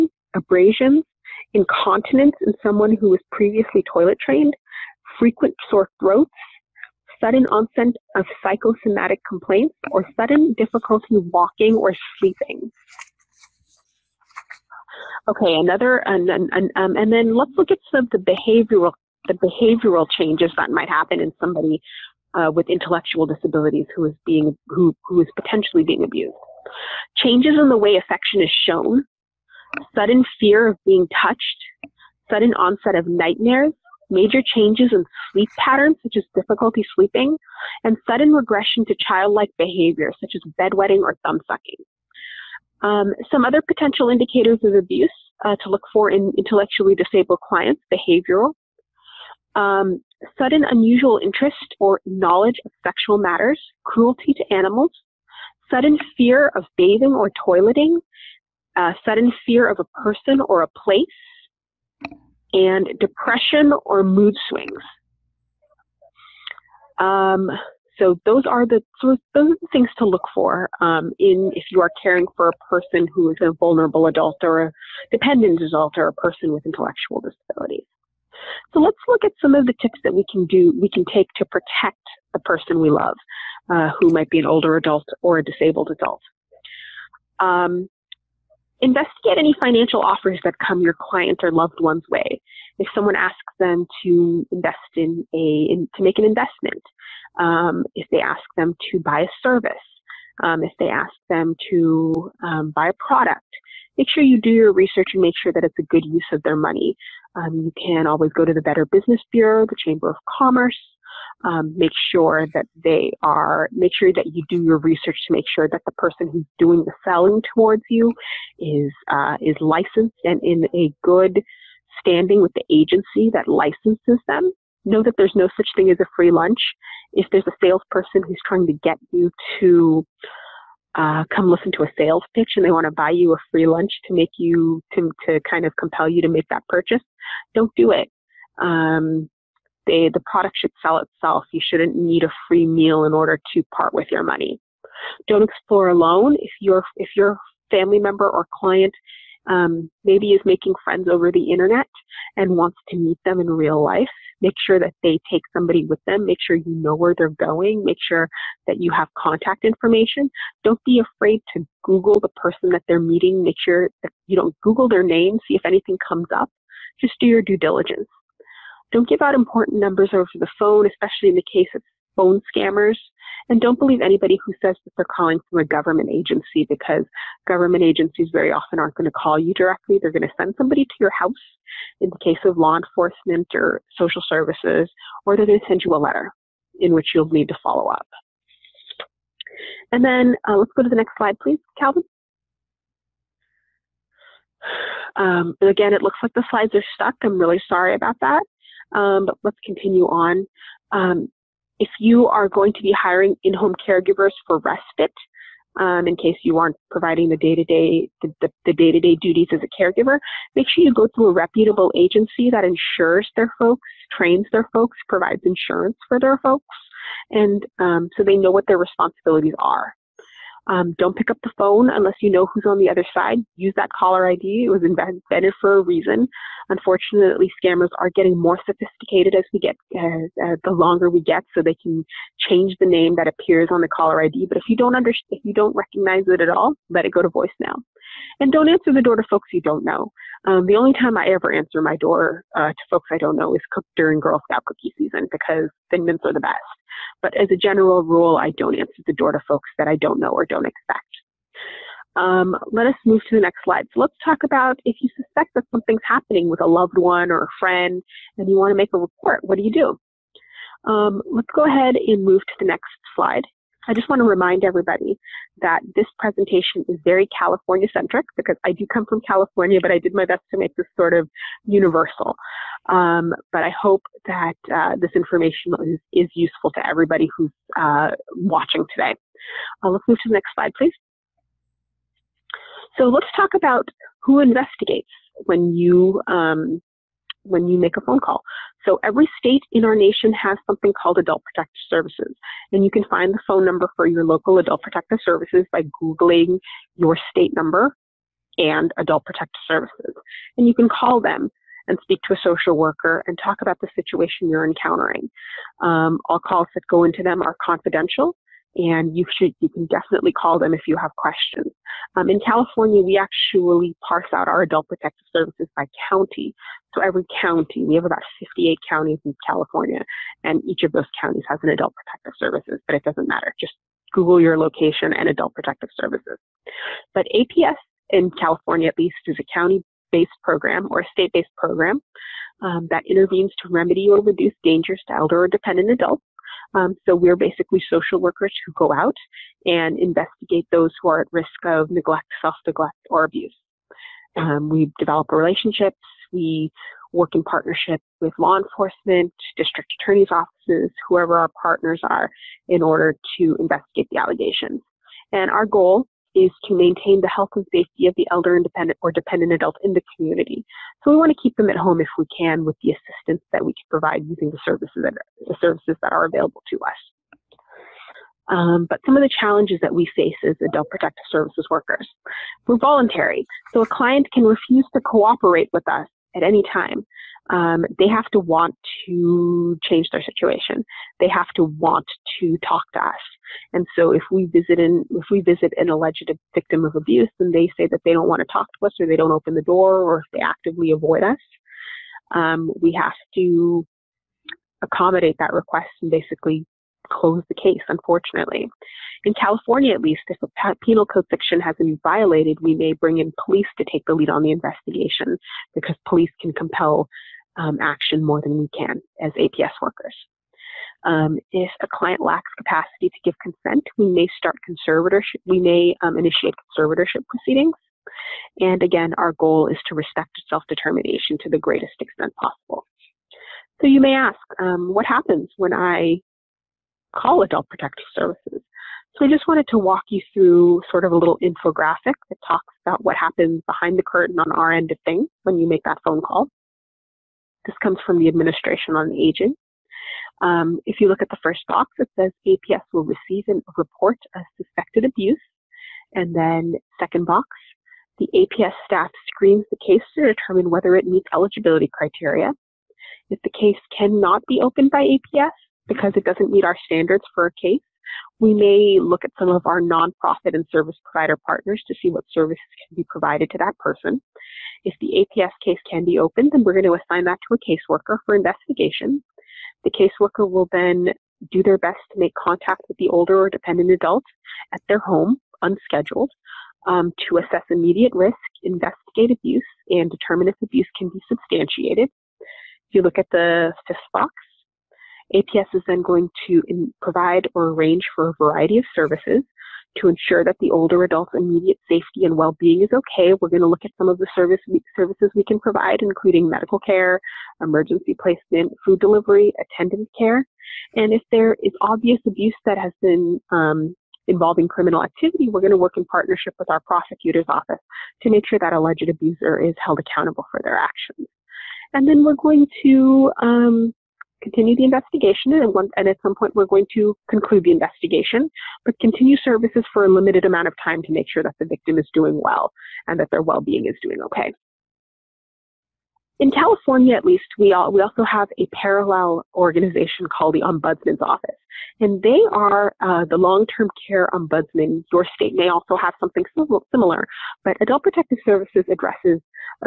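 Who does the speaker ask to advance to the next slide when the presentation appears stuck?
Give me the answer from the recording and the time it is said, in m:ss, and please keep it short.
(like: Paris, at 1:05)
Calvin, at 3:11.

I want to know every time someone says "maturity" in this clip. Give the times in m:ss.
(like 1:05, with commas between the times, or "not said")
not said.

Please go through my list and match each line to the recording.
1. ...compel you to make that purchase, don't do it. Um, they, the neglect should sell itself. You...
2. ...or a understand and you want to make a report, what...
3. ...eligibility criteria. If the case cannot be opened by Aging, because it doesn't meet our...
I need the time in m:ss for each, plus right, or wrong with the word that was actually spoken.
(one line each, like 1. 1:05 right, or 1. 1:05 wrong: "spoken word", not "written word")
1. 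2:15 wrong: "product", not "neglect"
2. 4:17 wrong: "friend", not "understand"
3. 7:31 wrong: "APS", not "Aging".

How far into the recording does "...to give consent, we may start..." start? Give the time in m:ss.
6:53.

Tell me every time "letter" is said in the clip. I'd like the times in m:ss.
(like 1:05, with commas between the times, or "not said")
3:05.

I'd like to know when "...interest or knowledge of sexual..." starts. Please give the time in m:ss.
0:51.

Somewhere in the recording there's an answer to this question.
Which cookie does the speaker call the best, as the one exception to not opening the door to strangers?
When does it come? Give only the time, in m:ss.
4:05.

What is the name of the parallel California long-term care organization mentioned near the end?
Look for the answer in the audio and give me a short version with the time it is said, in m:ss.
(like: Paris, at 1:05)
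Ombudsman's Office, at 8:50.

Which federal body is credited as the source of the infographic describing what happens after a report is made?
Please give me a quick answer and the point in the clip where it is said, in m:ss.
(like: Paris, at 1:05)
Administration on Aging, at 7:18.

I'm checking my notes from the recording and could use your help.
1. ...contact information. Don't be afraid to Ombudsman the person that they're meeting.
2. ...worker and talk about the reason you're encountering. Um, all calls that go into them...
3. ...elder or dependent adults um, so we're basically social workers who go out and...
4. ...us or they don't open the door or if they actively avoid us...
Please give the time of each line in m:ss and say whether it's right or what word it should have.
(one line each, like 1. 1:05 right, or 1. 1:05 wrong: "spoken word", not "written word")
1. 2:39 wrong: "Google", not "Ombudsman"
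2. 5:02 wrong: "situation", not "reason"
3. 5:35 right
4. 6:28 right.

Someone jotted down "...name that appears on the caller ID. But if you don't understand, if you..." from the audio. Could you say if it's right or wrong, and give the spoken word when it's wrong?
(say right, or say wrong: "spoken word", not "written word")
right.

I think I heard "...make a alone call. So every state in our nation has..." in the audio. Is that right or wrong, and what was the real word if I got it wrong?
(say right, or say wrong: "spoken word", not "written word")
wrong: "phone", not "alone".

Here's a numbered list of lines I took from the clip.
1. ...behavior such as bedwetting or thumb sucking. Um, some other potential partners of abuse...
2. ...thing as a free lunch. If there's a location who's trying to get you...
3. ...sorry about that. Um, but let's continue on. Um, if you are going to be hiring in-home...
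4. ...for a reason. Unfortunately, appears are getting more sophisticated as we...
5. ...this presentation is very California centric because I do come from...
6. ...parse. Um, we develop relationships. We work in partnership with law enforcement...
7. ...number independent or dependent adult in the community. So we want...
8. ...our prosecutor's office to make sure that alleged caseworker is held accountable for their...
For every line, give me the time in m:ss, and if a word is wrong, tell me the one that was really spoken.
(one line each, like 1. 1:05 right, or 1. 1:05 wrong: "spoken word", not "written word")
1. 0:39 wrong: "indicators", not "partners"
2. 2:05 wrong: "salesperson", not "location"
3. 3:17 right
4. 3:45 wrong: "scammers", not "appears"
5. 4:25 right
6. 5:43 wrong: "abuse", not "parse"
7. 5:58 wrong: "elder", not "number"
8. 8:26 wrong: "abuser", not "caseworker".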